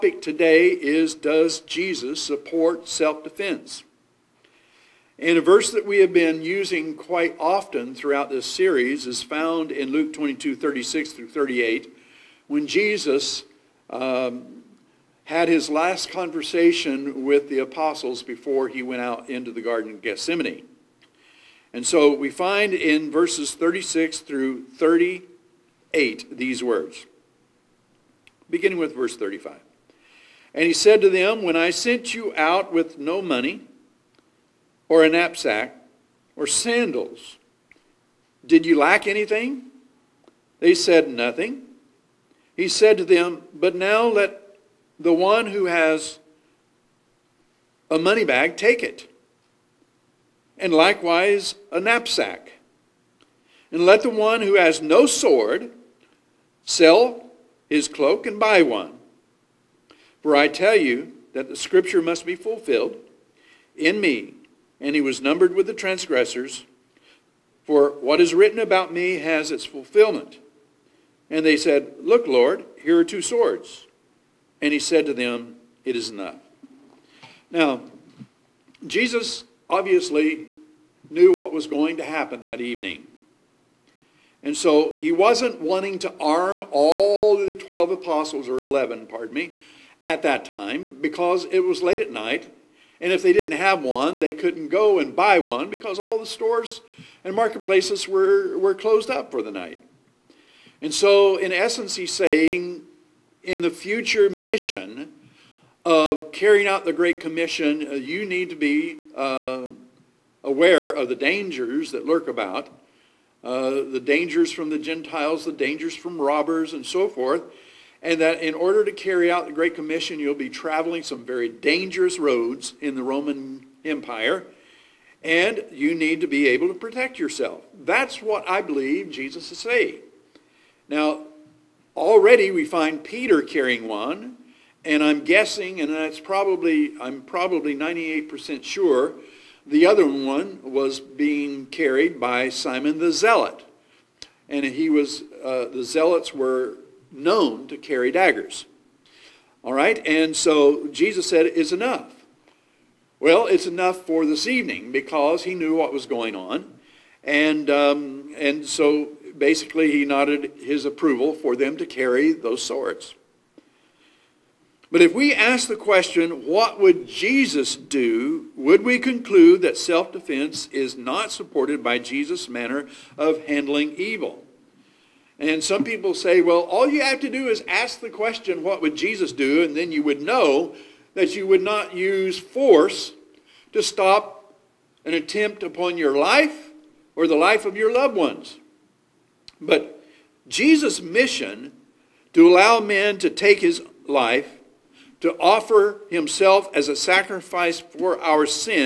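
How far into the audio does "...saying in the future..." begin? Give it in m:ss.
1:42.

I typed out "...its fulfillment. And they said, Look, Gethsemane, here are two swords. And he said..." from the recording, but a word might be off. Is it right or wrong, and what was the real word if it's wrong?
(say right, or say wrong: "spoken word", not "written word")
wrong: "Lord", not "Gethsemane".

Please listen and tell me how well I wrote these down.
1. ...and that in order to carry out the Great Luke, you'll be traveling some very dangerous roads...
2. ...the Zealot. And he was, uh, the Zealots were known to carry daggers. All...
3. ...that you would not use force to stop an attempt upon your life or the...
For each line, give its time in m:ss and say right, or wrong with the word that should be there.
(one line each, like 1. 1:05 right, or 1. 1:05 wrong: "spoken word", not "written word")
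1. 1:58 wrong: "Commission", not "Luke"
2. 2:22 right
3. 3:01 right.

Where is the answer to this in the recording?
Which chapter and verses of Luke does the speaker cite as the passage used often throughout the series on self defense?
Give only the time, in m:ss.
0:09.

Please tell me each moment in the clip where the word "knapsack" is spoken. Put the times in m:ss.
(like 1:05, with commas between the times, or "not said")
0:35, 0:51.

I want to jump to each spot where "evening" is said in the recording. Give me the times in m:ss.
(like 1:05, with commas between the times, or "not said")
1:22, 2:34.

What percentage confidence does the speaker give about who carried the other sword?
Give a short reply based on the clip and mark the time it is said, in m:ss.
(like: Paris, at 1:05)
98%, at 2:17.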